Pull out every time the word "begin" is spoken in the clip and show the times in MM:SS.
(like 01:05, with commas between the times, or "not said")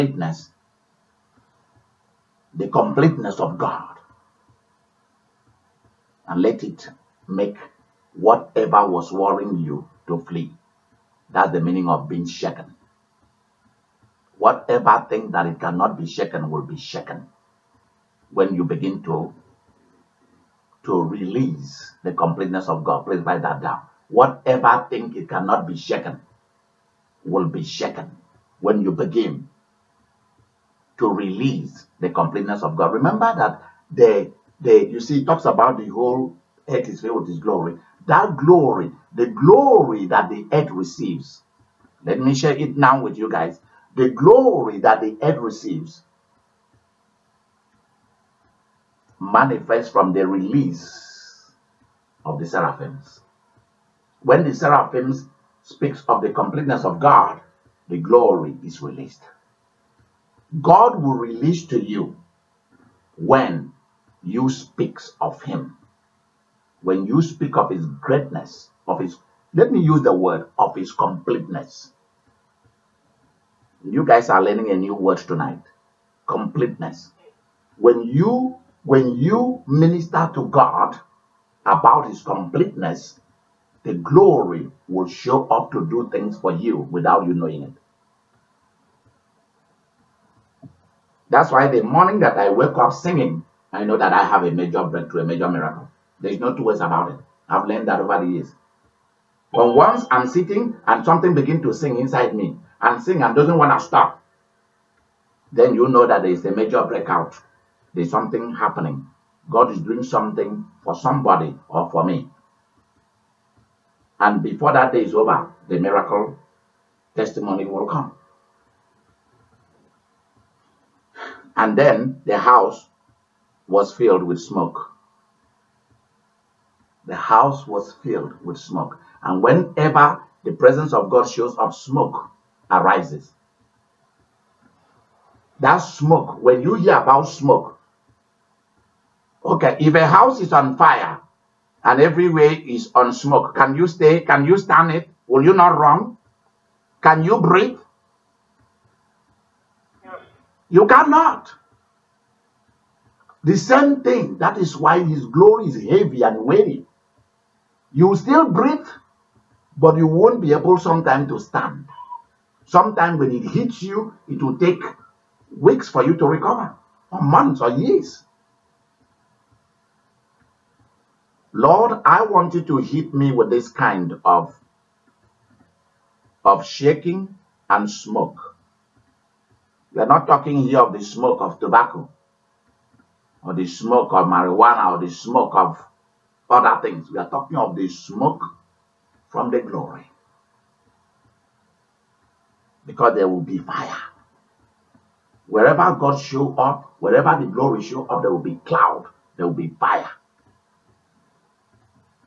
00:18, 00:28, 01:41.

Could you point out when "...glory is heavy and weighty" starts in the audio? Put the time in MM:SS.
02:35.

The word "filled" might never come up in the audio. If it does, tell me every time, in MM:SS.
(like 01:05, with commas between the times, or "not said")
00:36, 02:03, 02:08.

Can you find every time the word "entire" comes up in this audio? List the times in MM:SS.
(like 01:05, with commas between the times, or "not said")
not said.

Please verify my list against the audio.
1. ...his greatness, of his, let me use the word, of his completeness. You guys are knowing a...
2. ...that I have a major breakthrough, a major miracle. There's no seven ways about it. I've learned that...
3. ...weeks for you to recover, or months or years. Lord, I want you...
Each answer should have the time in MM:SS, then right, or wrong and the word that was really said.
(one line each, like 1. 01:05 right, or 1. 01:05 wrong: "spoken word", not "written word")
1. 01:07 wrong: "learning", not "knowing"
2. 01:33 wrong: "two", not "seven"
3. 02:45 right.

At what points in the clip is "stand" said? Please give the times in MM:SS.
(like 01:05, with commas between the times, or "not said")
02:24, 02:41.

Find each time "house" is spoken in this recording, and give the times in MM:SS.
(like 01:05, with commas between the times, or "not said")
02:02, 02:07, 02:20.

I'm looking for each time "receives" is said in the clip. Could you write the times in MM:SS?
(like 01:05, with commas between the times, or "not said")
00:40, 00:45.